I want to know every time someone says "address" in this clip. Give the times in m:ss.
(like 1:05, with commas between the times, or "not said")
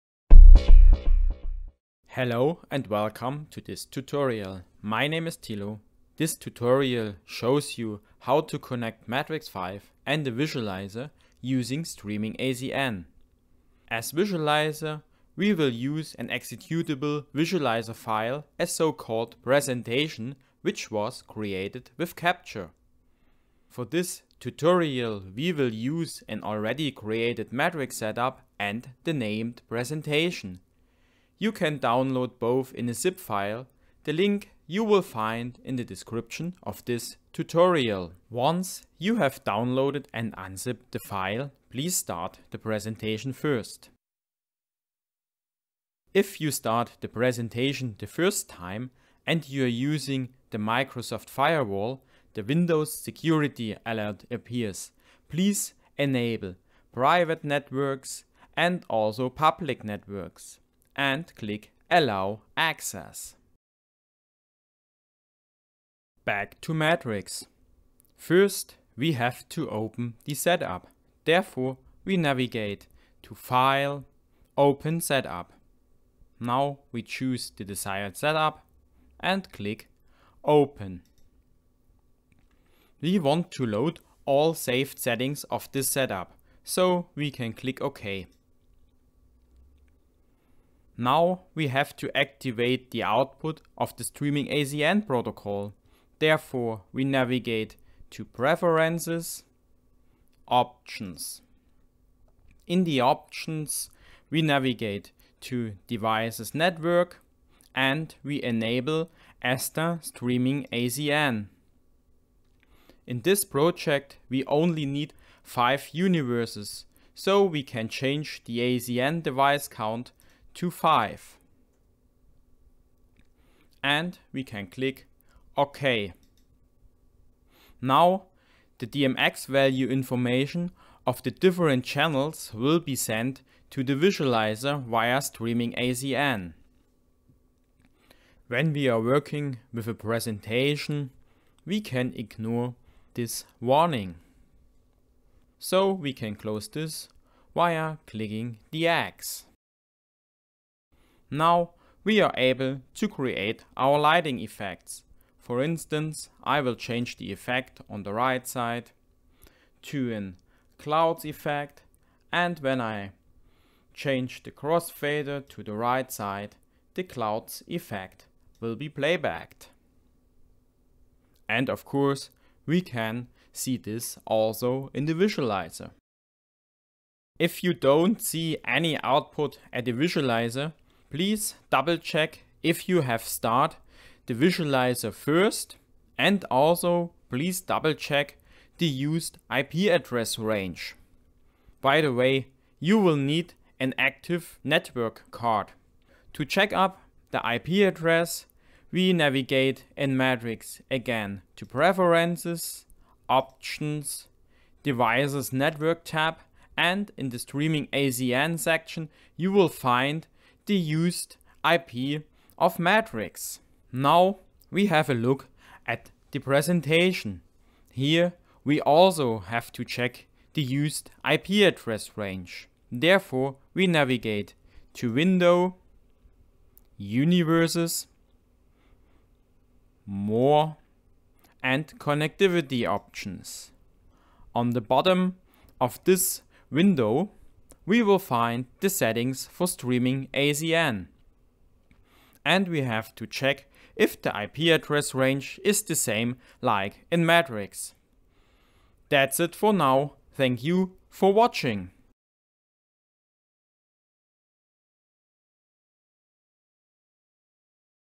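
3:09, 3:17, 3:41, 4:04.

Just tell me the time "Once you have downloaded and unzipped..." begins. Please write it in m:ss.
0:38.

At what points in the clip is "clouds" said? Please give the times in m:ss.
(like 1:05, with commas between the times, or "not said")
2:40, 2:47.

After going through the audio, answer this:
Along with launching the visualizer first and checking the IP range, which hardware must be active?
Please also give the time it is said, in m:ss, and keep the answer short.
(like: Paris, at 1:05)
Network card, at 3:14.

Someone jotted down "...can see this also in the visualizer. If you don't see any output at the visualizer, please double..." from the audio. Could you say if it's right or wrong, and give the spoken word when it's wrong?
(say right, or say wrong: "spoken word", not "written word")
right.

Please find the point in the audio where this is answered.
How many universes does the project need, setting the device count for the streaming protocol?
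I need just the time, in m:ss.
1:55.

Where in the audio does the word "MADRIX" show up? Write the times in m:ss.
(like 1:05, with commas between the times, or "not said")
0:09, 0:27, 1:06, 3:20, 3:32, 4:07.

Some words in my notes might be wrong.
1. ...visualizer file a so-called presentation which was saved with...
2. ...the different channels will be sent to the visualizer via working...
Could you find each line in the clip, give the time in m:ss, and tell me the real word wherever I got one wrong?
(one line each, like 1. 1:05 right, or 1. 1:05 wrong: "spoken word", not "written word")
1. 0:17 wrong: "created", not "saved"
2. 2:11 wrong: "streaming", not "working".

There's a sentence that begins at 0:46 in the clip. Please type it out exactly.
If you start the presentation the first time and you are using the Microsoft Firewall, the Windows security alert appears.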